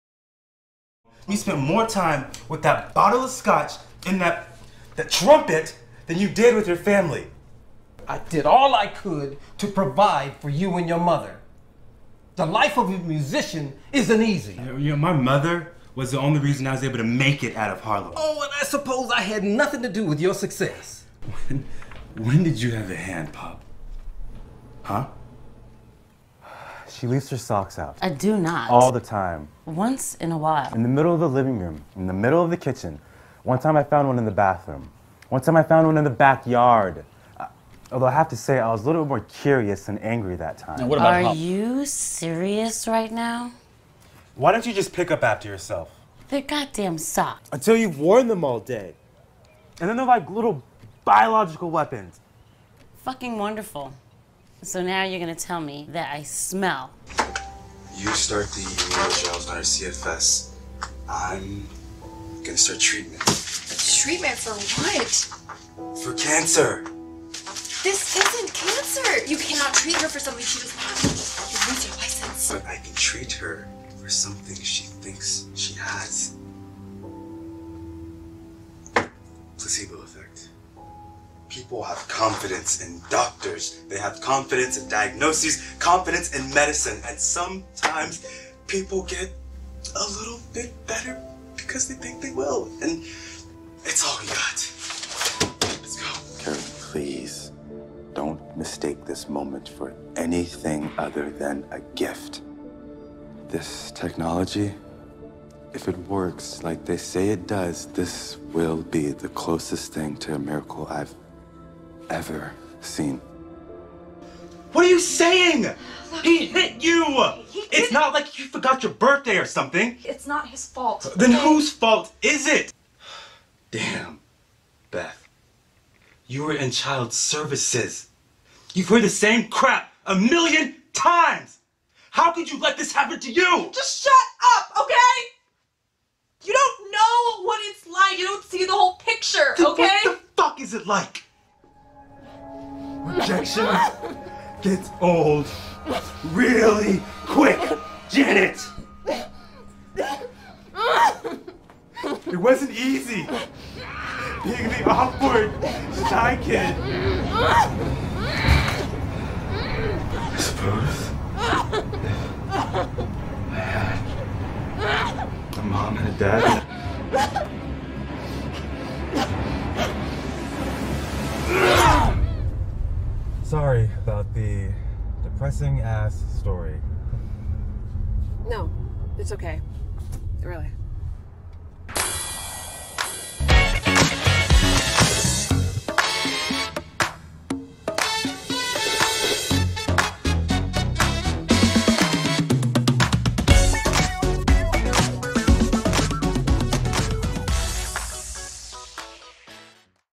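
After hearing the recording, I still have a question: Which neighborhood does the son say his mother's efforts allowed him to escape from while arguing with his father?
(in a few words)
Harlem.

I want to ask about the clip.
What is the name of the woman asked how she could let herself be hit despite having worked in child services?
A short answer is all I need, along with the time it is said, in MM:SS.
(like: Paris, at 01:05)
Beth, at 02:04.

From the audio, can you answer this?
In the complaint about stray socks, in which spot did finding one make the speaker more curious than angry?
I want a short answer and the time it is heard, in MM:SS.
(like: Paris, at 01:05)
the backyard, at 00:36.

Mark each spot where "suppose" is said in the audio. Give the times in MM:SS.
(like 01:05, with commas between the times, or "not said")
00:18, 02:40.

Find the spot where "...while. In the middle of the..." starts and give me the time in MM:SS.
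00:30.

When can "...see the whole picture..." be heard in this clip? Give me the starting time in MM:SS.
02:18.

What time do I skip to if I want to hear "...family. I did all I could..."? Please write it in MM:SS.
00:06.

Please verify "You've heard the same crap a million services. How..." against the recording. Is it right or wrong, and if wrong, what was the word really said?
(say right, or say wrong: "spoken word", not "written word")
wrong: "times", not "services".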